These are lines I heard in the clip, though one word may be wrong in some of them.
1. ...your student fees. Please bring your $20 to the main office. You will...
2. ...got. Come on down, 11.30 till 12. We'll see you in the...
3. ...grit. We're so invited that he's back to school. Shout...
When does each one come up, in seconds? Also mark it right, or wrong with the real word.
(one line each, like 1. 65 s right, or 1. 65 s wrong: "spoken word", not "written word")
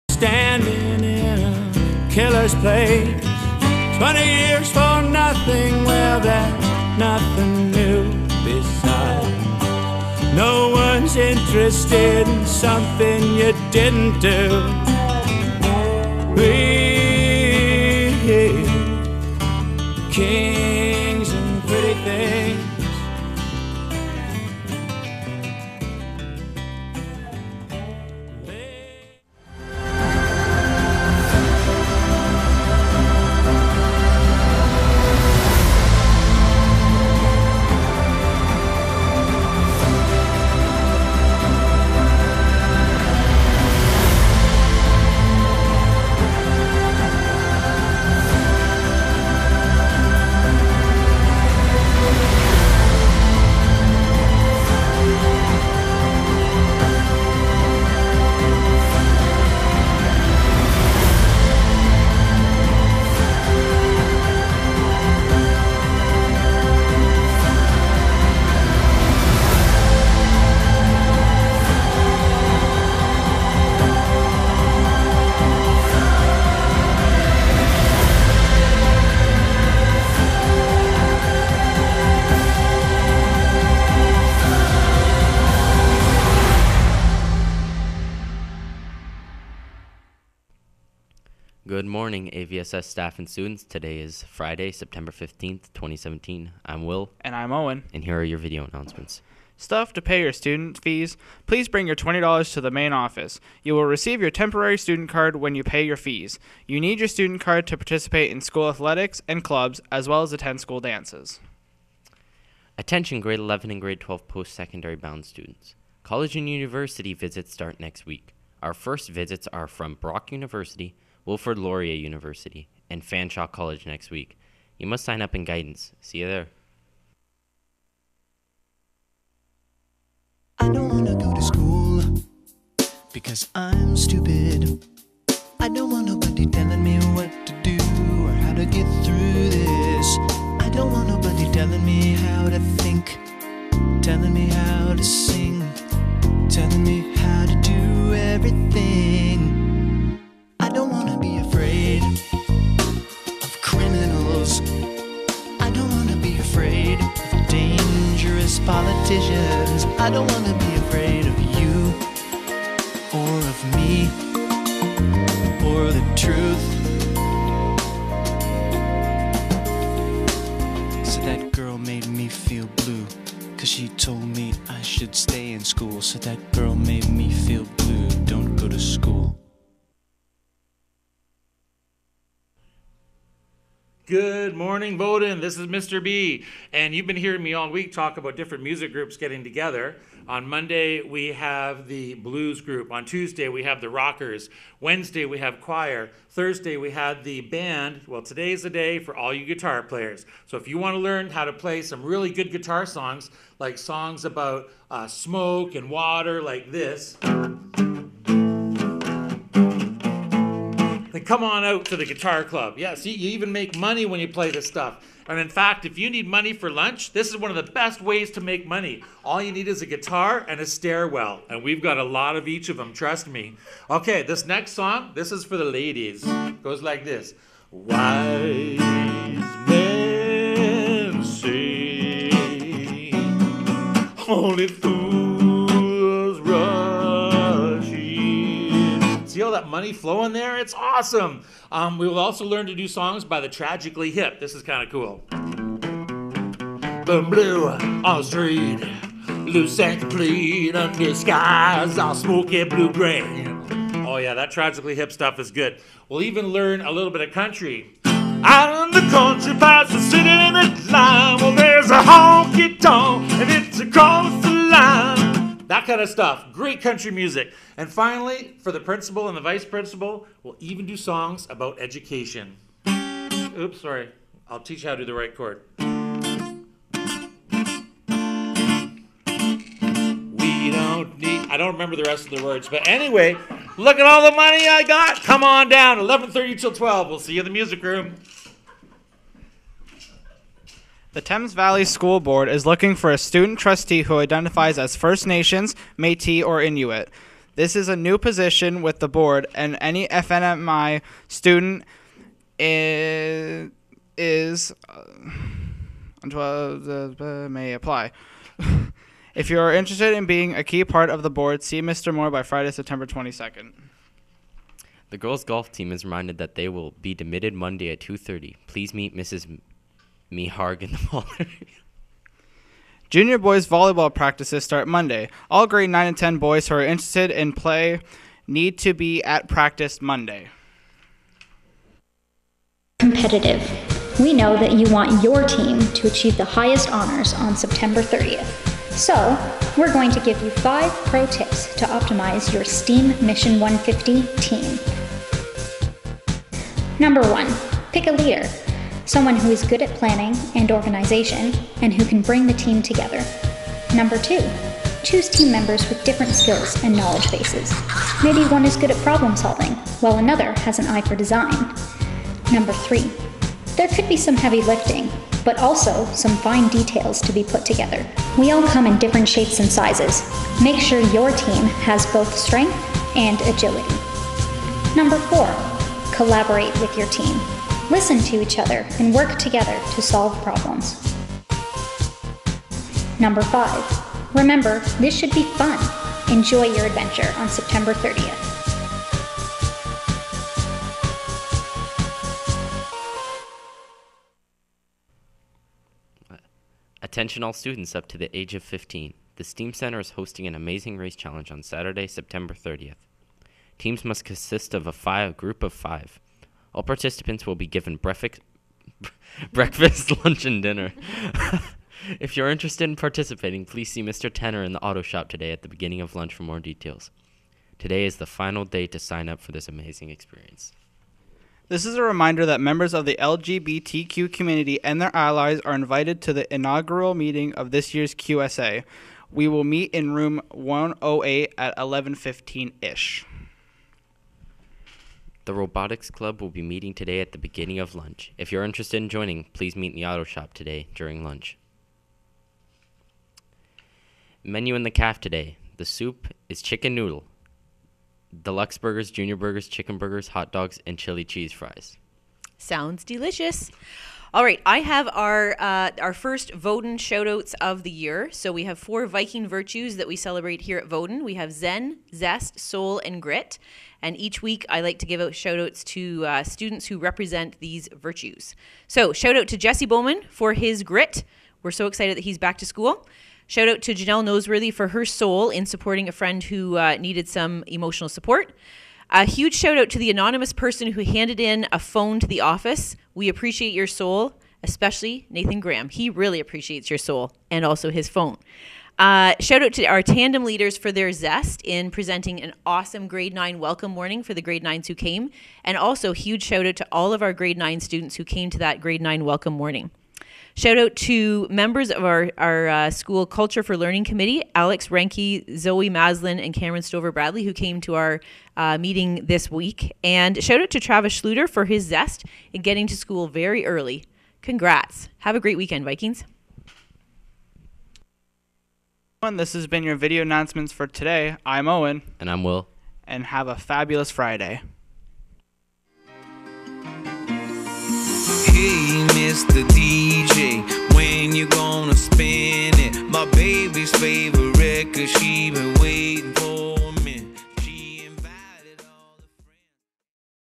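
1. 100 s right
2. 284 s right
3. 470 s wrong: "excited", not "invited".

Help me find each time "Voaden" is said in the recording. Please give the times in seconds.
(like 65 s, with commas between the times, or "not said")
184 s, 456 s, 460 s.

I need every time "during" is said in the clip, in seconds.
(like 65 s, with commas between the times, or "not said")
440 s.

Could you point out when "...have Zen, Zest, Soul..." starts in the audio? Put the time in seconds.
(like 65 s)
461 s.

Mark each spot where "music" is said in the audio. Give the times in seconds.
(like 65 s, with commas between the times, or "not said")
188 s, 267 s, 287 s.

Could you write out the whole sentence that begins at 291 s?
The Thames Valley School Board is looking for a student trustee who identifies as First Nations, Metis, or Inuit.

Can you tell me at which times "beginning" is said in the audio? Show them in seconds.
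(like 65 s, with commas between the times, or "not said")
415 s, 437 s.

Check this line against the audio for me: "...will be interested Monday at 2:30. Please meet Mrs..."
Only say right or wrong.
wrong.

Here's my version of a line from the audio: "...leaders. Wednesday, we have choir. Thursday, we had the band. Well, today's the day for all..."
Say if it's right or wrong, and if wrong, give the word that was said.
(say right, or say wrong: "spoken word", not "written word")
wrong: "rockers", not "leaders".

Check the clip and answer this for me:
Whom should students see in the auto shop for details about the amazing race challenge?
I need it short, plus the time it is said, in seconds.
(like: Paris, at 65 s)
Mr. Tenner, at 414 s.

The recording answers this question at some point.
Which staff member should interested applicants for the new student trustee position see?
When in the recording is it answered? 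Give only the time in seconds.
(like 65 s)
311 s.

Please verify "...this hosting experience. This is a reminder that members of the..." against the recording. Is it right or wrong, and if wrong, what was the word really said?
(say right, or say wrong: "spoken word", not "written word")
wrong: "amazing", not "hosting".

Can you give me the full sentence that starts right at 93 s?
Today is Friday, September 15th, 2017.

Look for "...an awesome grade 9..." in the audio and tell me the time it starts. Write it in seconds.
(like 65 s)
492 s.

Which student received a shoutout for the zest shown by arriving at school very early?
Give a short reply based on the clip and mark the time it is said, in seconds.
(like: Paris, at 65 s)
Travis Schluter, at 510 s.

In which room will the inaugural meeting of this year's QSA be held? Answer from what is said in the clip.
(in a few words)
Room 108.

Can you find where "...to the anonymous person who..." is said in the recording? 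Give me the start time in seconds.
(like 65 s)
479 s.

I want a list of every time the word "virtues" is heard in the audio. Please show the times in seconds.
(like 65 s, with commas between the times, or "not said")
459 s, 467 s.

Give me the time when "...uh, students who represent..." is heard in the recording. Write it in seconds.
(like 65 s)
466 s.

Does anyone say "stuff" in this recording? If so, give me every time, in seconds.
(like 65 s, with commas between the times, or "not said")
99 s, 214 s, 255 s, 266 s.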